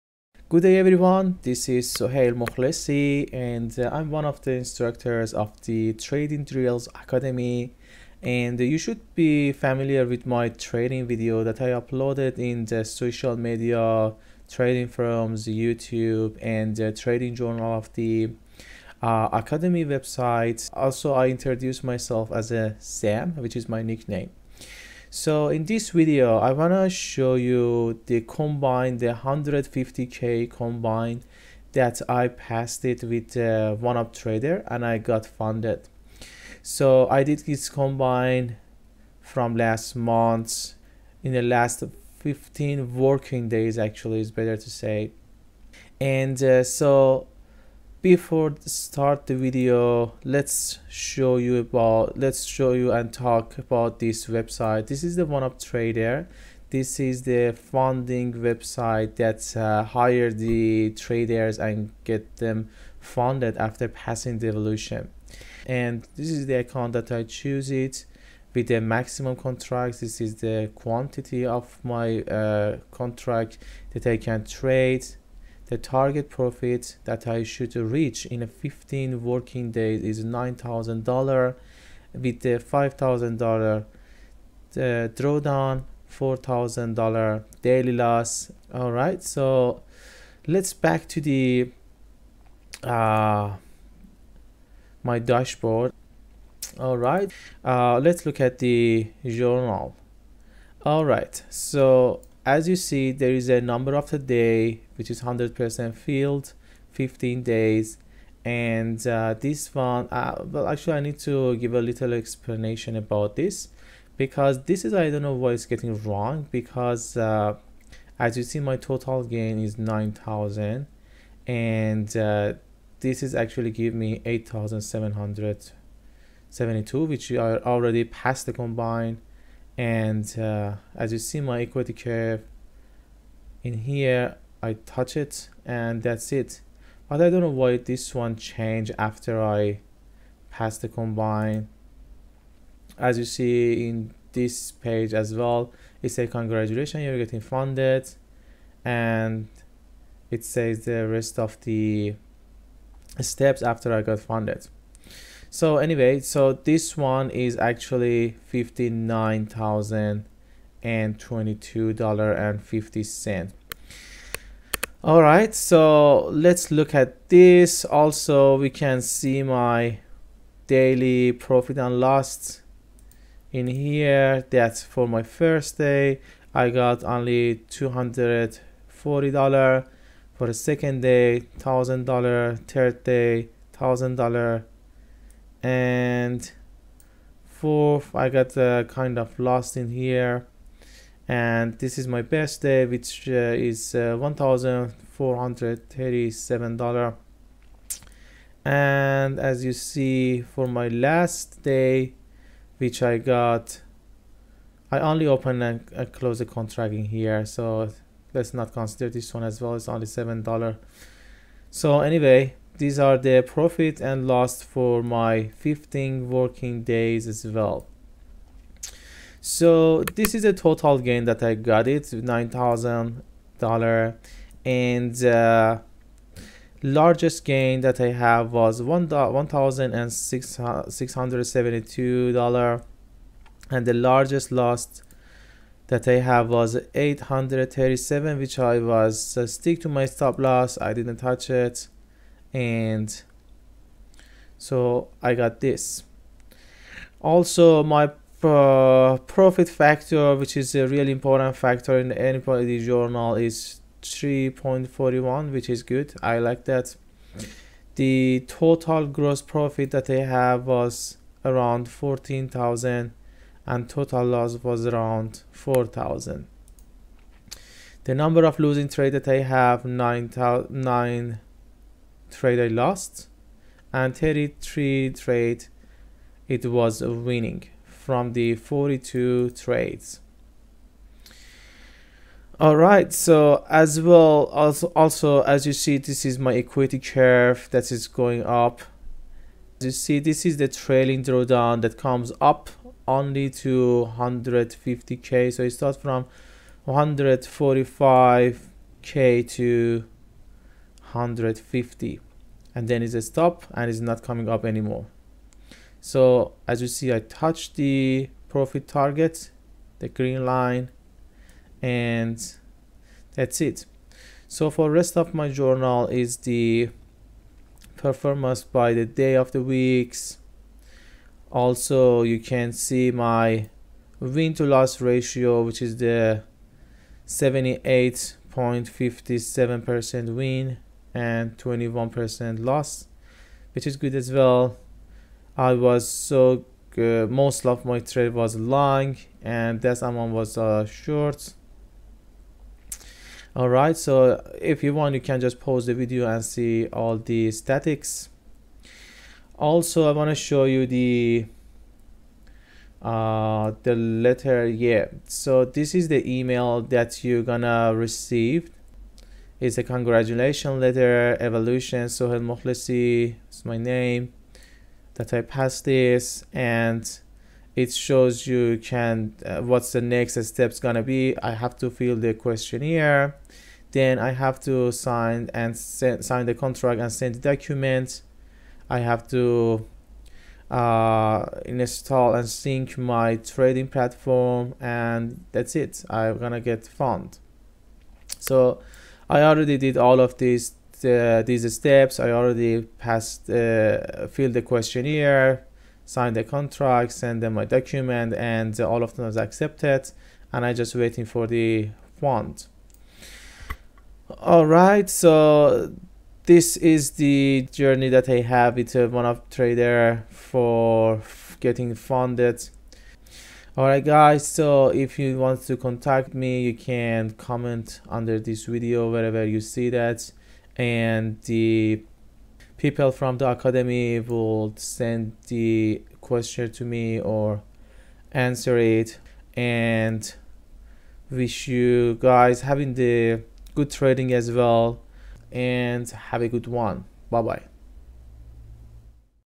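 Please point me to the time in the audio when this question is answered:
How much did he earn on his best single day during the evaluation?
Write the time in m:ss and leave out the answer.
3:14.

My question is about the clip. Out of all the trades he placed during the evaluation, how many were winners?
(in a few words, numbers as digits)
33.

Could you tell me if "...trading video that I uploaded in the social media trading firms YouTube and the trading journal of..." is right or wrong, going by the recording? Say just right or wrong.
right.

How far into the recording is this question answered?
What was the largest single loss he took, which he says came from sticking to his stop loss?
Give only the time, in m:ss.
3:56.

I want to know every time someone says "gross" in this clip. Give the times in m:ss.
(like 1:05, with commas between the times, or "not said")
4:19.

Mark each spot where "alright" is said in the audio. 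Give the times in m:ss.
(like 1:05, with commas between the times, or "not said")
5:43, 6:53.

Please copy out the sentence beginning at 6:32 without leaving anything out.
I already passed uh, filled the questionnaire, signed the contract, send them my document, and all of them was accepted.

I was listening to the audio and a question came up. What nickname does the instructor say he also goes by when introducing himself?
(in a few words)
Sam.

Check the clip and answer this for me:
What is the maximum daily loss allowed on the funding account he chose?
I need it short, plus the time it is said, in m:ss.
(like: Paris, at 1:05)
$4,000, at 1:26.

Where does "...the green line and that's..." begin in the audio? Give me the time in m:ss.
5:09.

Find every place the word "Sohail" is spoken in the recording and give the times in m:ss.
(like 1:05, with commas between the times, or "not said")
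0:01, 6:02.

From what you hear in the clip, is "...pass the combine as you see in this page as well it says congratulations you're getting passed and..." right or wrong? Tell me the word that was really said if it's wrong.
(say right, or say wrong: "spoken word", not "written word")
wrong: "funded", not "passed".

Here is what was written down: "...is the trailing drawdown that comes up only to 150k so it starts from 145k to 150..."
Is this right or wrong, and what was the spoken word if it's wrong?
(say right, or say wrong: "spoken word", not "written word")
right.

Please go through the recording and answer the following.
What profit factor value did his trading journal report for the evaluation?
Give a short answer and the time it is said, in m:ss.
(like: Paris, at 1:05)
3.41, at 4:14.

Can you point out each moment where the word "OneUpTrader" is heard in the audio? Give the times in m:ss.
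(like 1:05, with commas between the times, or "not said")
0:33, 0:55, 6:49.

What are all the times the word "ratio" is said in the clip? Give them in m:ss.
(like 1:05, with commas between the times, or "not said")
5:25.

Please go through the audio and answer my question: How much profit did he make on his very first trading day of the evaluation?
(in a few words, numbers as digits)
$240.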